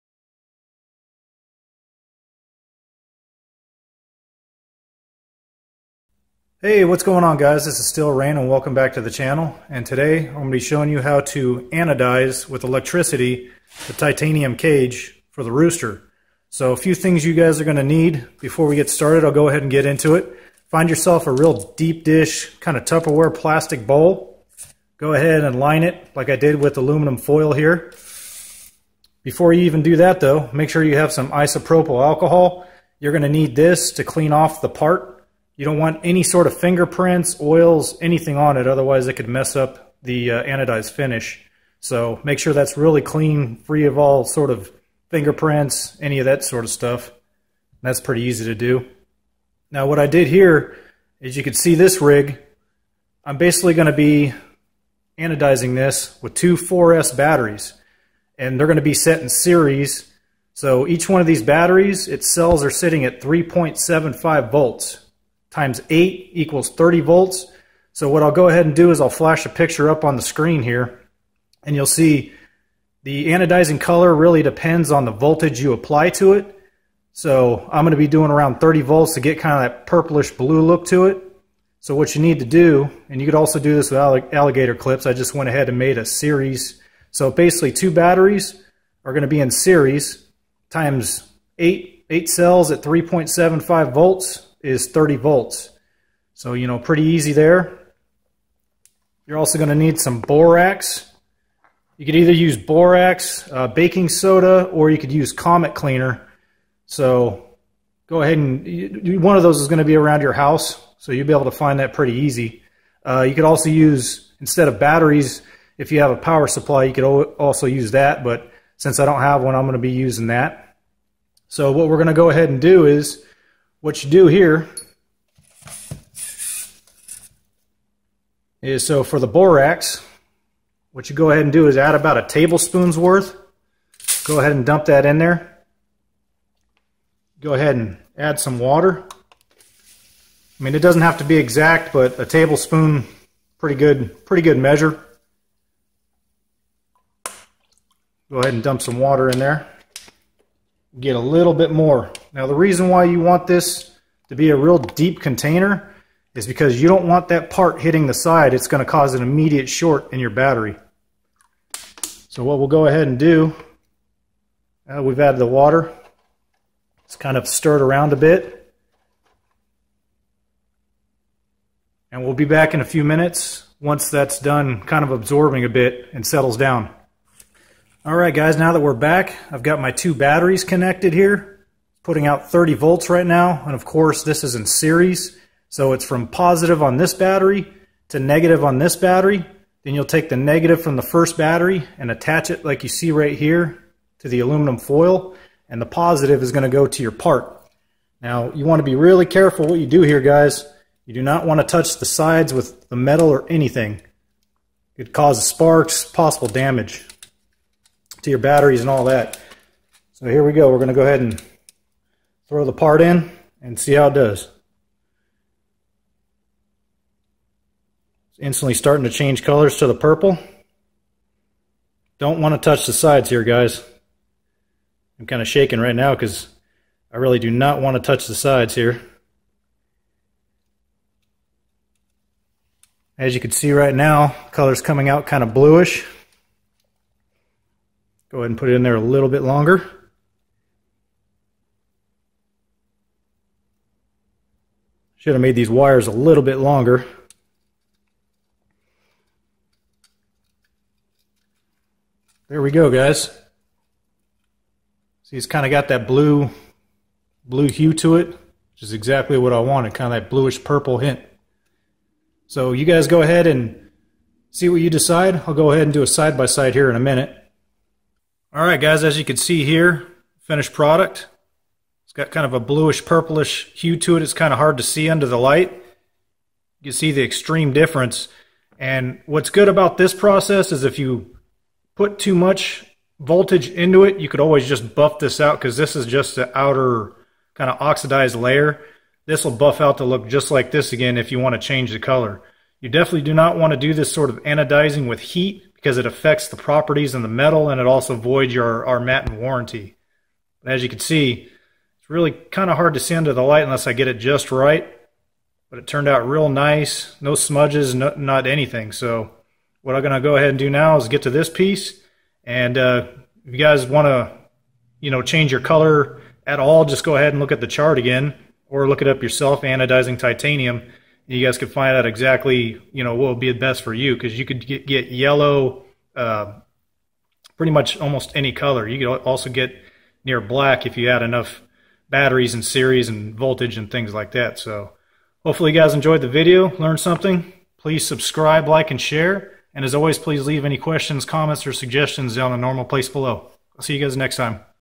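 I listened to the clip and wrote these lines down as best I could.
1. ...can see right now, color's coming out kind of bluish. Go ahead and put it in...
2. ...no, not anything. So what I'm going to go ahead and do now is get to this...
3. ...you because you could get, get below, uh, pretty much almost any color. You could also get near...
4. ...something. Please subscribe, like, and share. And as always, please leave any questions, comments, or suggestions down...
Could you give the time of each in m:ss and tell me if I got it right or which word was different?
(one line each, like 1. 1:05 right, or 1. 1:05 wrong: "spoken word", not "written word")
1. 3:53 right
2. 5:07 right
3. 5:23 wrong: "yellow", not "below"
4. 5:36 right.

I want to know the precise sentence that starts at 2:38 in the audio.
It's going to cause an immediate short in your battery.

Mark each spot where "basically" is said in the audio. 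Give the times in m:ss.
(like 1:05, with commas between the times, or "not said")
0:53, 1:27.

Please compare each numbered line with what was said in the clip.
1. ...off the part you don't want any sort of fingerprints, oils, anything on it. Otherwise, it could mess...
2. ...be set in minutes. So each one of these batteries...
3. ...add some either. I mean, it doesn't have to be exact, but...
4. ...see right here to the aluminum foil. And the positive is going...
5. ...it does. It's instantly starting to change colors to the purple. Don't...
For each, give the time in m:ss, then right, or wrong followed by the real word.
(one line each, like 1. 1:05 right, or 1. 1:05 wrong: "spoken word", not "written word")
1. 0:34 right
2. 0:58 wrong: "series", not "minutes"
3. 2:18 wrong: "water", not "either"
4. 3:12 right
5. 3:34 right.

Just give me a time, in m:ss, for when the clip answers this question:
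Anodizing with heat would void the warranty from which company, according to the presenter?
4:58.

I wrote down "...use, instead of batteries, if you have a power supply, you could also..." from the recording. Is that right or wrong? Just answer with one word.
right.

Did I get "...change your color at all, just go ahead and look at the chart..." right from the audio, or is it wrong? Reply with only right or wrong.
right.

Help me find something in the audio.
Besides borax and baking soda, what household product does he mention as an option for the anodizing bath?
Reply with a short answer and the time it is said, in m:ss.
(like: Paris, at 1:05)
Comet Cleaner, at 1:45.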